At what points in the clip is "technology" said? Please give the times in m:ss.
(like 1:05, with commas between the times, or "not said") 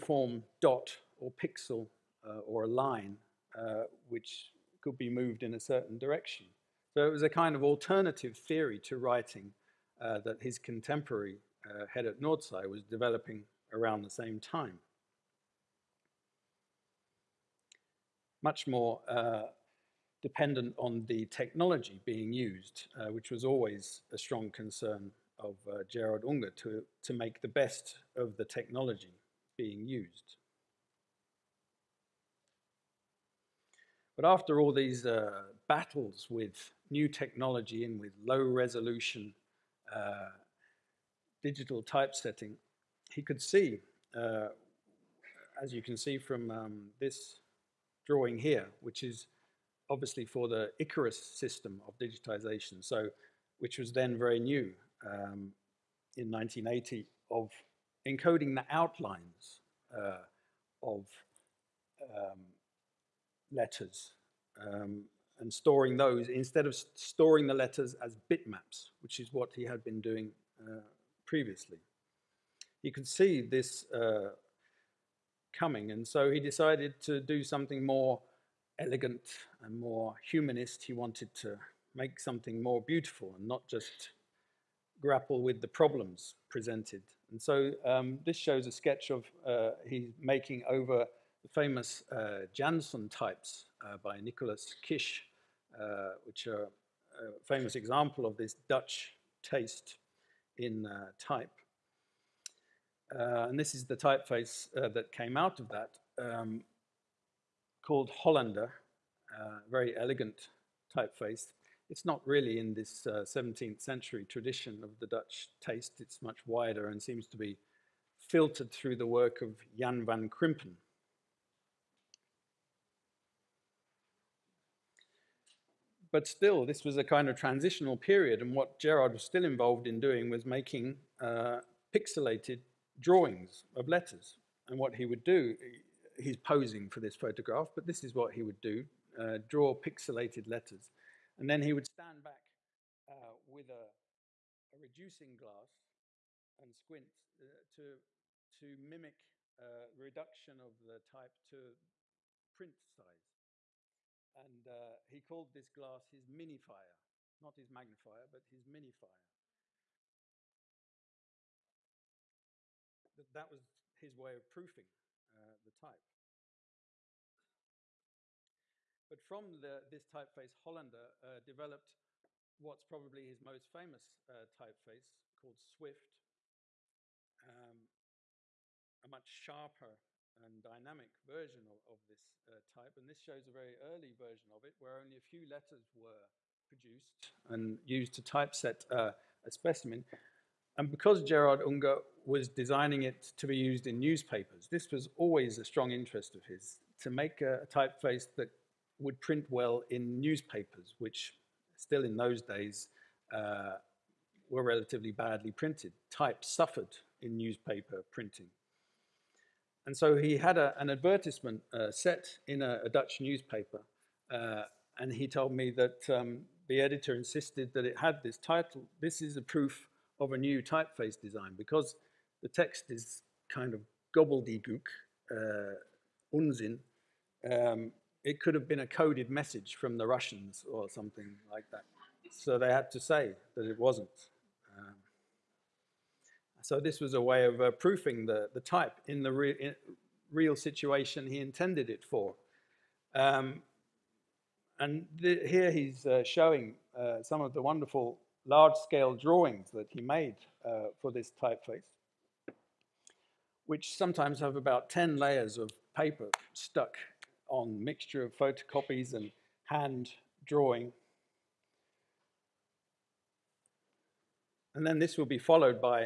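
0:21, 0:28, 0:37.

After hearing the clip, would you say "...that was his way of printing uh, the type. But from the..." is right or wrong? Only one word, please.
wrong.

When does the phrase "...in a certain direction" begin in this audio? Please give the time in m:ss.
0:05.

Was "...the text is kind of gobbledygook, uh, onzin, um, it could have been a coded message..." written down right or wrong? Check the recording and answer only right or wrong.
right.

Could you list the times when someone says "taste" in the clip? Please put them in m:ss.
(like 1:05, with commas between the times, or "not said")
1:39, 1:55.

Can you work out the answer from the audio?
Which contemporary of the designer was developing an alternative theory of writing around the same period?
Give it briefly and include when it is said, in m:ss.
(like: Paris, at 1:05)
Gerrit Noordzij, at 0:11.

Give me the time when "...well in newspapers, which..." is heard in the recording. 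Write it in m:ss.
3:19.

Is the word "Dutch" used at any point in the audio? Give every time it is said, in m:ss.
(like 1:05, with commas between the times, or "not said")
1:38, 1:55, 3:32.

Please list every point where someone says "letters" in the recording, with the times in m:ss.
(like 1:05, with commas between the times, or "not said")
1:03, 1:07, 2:13, 2:20, 3:05.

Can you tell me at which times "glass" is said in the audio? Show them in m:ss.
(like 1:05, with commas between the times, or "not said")
2:25, 2:35.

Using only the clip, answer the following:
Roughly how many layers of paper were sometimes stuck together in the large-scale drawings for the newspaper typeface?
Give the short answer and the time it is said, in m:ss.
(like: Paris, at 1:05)
10, at 4:14.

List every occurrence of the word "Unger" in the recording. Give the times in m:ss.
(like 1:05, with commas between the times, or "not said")
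0:26, 3:11.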